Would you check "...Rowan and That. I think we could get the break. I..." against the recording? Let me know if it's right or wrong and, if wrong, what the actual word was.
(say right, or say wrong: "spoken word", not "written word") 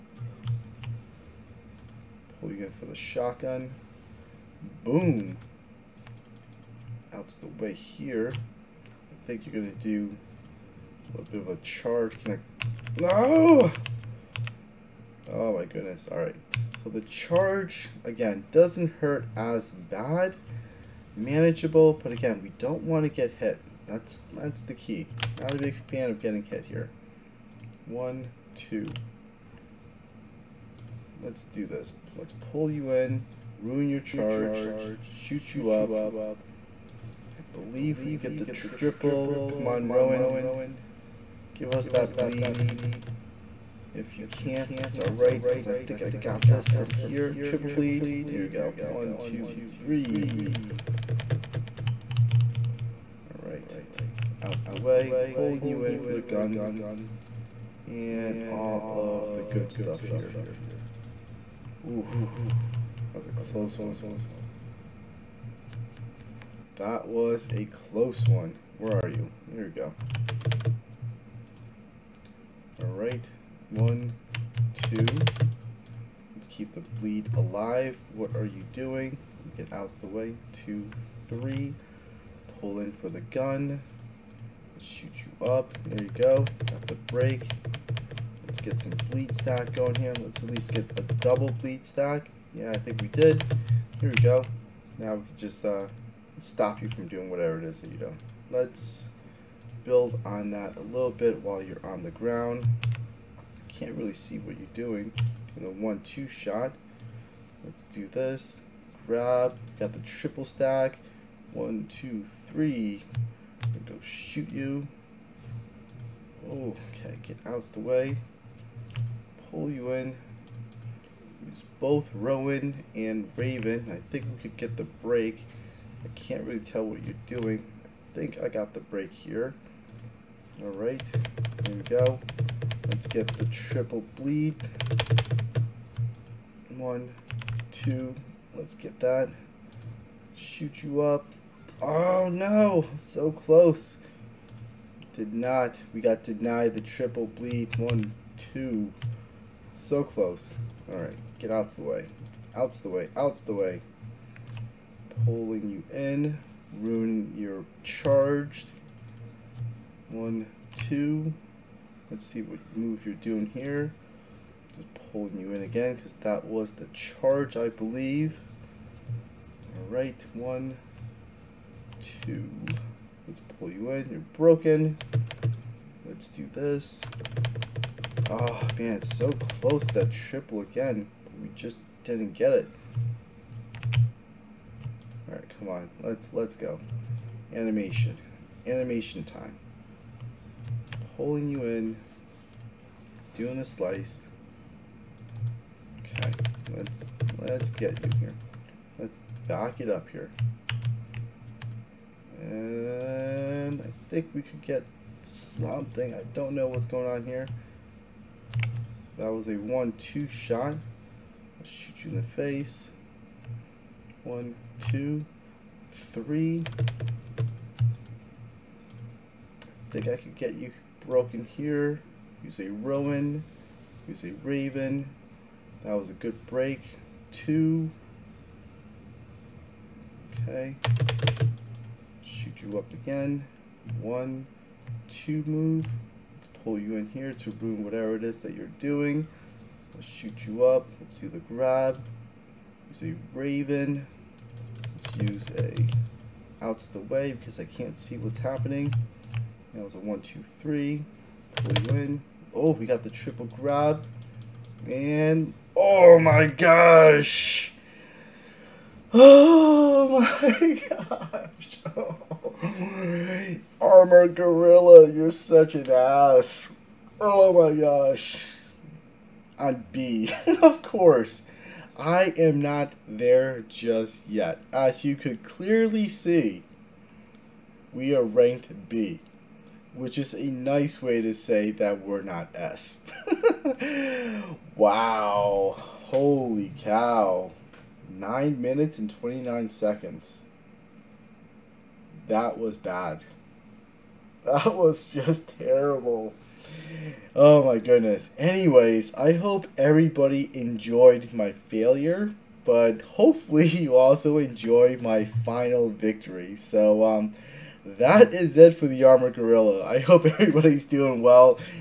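wrong: "Raven", not "That".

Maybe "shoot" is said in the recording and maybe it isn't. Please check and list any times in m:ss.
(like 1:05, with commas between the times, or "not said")
0:35, 1:24, 1:54, 2:20, 3:31, 3:52, 4:00.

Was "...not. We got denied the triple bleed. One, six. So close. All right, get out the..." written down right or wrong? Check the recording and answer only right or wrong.
wrong.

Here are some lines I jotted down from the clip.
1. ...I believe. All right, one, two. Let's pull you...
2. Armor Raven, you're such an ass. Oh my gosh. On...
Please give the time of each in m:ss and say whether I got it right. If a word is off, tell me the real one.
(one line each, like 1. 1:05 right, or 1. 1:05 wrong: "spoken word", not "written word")
1. 2:47 right
2. 4:23 wrong: "Gorilla", not "Raven".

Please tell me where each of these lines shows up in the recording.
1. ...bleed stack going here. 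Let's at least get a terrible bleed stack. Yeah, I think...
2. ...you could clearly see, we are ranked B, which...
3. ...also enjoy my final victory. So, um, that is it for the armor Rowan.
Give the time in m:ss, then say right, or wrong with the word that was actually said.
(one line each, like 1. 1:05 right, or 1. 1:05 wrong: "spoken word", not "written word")
1. 1:29 wrong: "double", not "terrible"
2. 4:35 right
3. 5:03 wrong: "Gorilla", not "Rowan".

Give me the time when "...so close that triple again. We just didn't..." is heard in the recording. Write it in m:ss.
2:59.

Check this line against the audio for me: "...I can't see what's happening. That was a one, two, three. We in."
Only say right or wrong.
right.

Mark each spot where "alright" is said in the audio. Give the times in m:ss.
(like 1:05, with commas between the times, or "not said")
0:44, 0:53, 1:12.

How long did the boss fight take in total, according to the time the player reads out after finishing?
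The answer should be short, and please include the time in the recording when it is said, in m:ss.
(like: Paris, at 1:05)
9 minutes and 29 seconds, at 4:48.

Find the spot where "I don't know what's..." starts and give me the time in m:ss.
3:26.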